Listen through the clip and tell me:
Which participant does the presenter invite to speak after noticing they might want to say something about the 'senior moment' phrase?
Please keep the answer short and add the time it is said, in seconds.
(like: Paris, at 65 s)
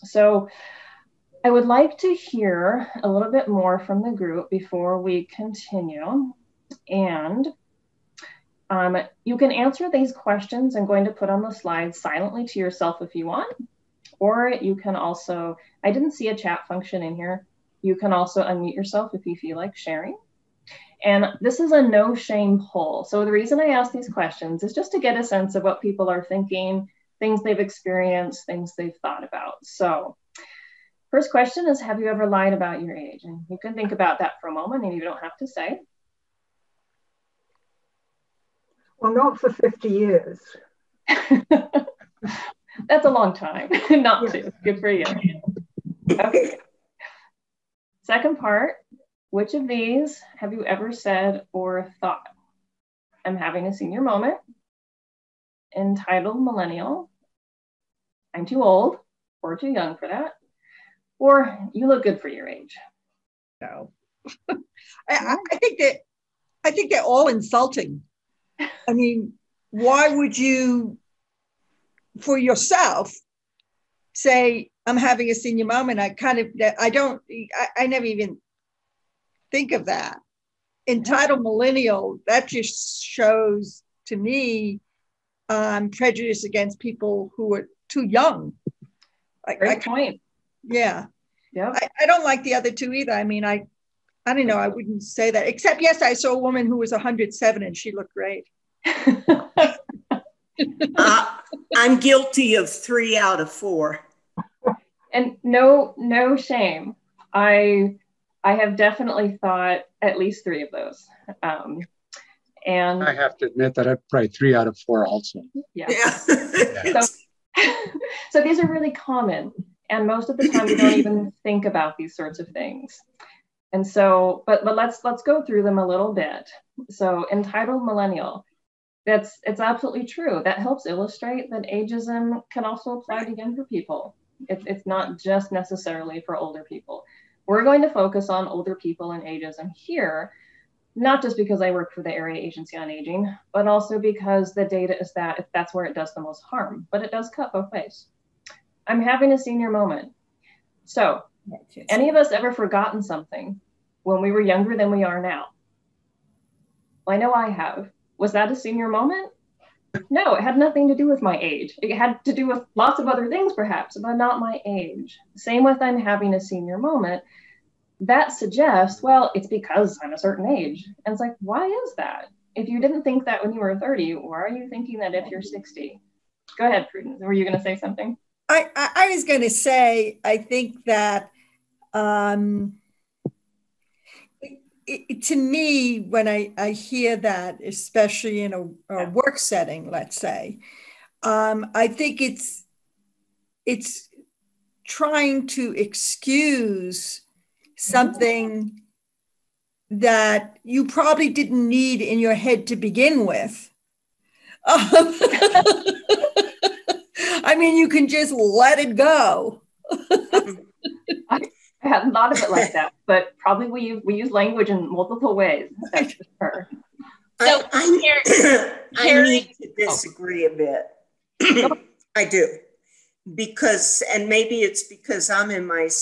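Prudence, at 176 s.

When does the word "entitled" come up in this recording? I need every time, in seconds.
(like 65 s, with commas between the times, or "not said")
55 s, 80 s, 127 s.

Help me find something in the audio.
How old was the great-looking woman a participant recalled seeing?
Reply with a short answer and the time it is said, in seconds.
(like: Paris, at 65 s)
107, at 96 s.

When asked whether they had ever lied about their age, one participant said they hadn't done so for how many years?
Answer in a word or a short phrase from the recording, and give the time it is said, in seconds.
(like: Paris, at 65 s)
50, at 39 s.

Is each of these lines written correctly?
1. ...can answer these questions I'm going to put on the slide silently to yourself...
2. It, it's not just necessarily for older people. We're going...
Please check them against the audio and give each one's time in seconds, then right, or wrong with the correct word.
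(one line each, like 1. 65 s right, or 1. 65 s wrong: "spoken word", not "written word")
1. 9 s right
2. 134 s right.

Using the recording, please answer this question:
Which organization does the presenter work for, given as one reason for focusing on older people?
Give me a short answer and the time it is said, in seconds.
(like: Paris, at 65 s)
Area Agency on Aging, at 142 s.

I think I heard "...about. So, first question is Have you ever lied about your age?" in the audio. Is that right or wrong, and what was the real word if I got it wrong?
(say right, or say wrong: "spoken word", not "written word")
right.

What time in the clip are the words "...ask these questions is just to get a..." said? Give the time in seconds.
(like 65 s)
23 s.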